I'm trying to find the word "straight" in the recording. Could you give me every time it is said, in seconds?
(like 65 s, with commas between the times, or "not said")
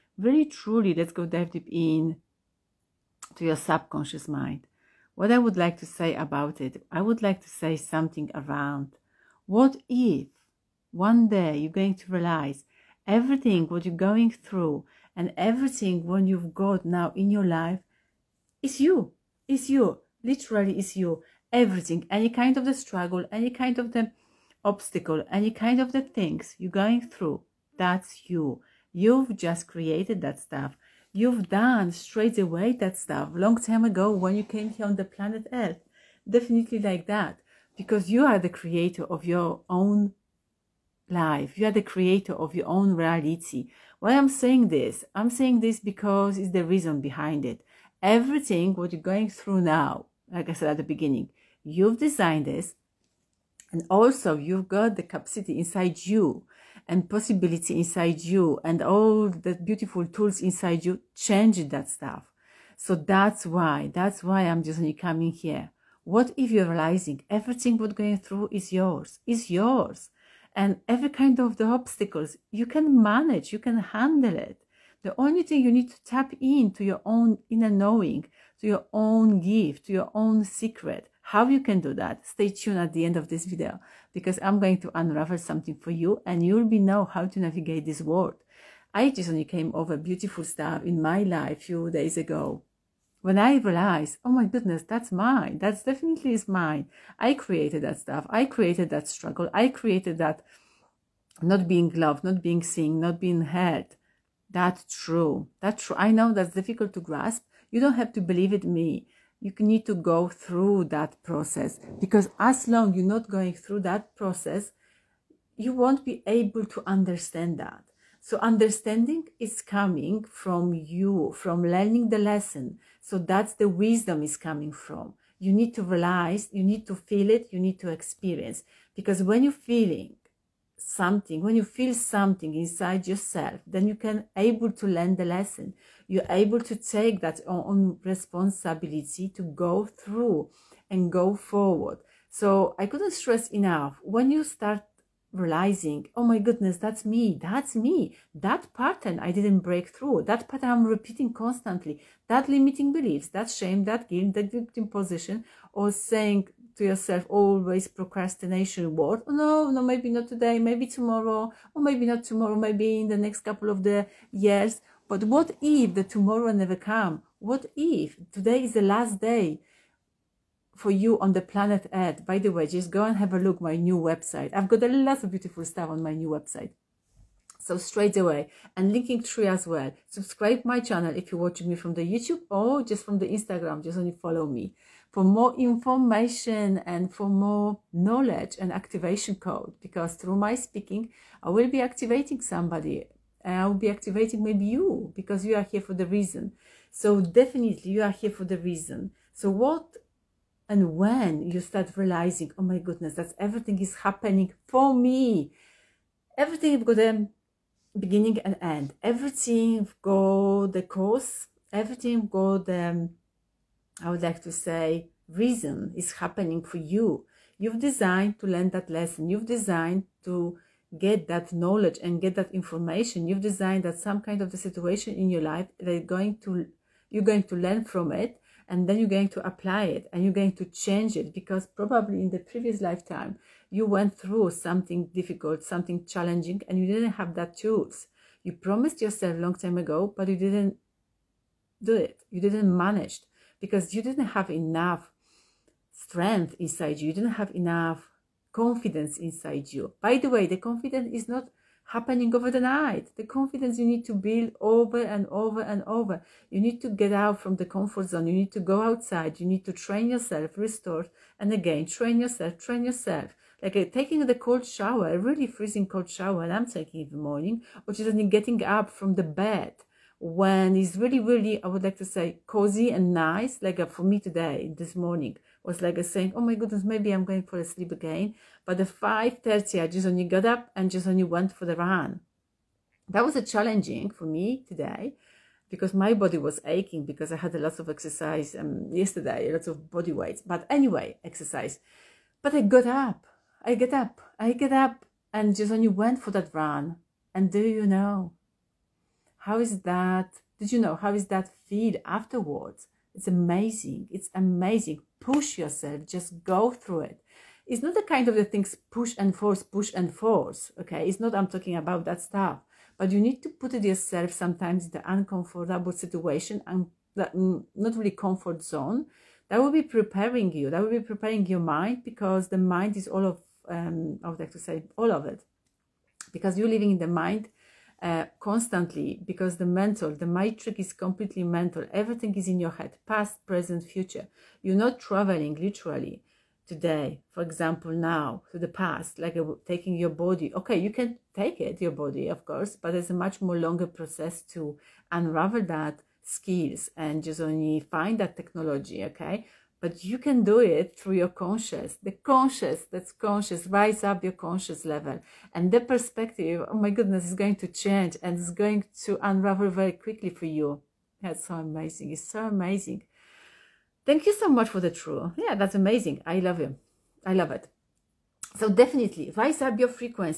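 31 s, 177 s.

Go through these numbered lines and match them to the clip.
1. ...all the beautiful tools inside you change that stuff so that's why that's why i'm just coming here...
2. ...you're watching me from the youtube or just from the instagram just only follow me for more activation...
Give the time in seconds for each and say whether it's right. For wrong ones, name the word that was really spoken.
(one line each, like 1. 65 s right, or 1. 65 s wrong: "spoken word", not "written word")
1. 58 s right
2. 181 s wrong: "information", not "activation".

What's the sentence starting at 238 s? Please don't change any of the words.
You promised yourself long time ago, but you didn't do it.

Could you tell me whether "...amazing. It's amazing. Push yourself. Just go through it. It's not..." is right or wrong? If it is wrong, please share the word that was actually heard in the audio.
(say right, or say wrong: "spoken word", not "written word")
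right.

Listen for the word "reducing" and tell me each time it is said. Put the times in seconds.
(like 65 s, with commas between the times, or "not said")
not said.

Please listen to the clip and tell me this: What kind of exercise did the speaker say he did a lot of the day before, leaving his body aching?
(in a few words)
body weight.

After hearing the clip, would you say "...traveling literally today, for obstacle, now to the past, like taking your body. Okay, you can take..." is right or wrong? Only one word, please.
wrong.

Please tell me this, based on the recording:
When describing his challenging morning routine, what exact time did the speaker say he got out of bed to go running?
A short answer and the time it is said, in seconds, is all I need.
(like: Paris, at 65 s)
5:30, at 278 s.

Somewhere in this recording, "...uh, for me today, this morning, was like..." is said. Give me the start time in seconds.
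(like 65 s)
273 s.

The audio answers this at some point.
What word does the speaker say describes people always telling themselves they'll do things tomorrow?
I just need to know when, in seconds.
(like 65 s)
157 s.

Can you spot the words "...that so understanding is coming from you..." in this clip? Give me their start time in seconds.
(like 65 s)
117 s.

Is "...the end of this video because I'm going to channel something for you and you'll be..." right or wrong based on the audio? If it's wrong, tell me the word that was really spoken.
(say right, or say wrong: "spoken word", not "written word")
wrong: "unravel", not "channel".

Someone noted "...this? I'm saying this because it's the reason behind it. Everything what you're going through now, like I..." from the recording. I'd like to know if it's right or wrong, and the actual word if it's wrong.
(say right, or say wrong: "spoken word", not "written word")
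right.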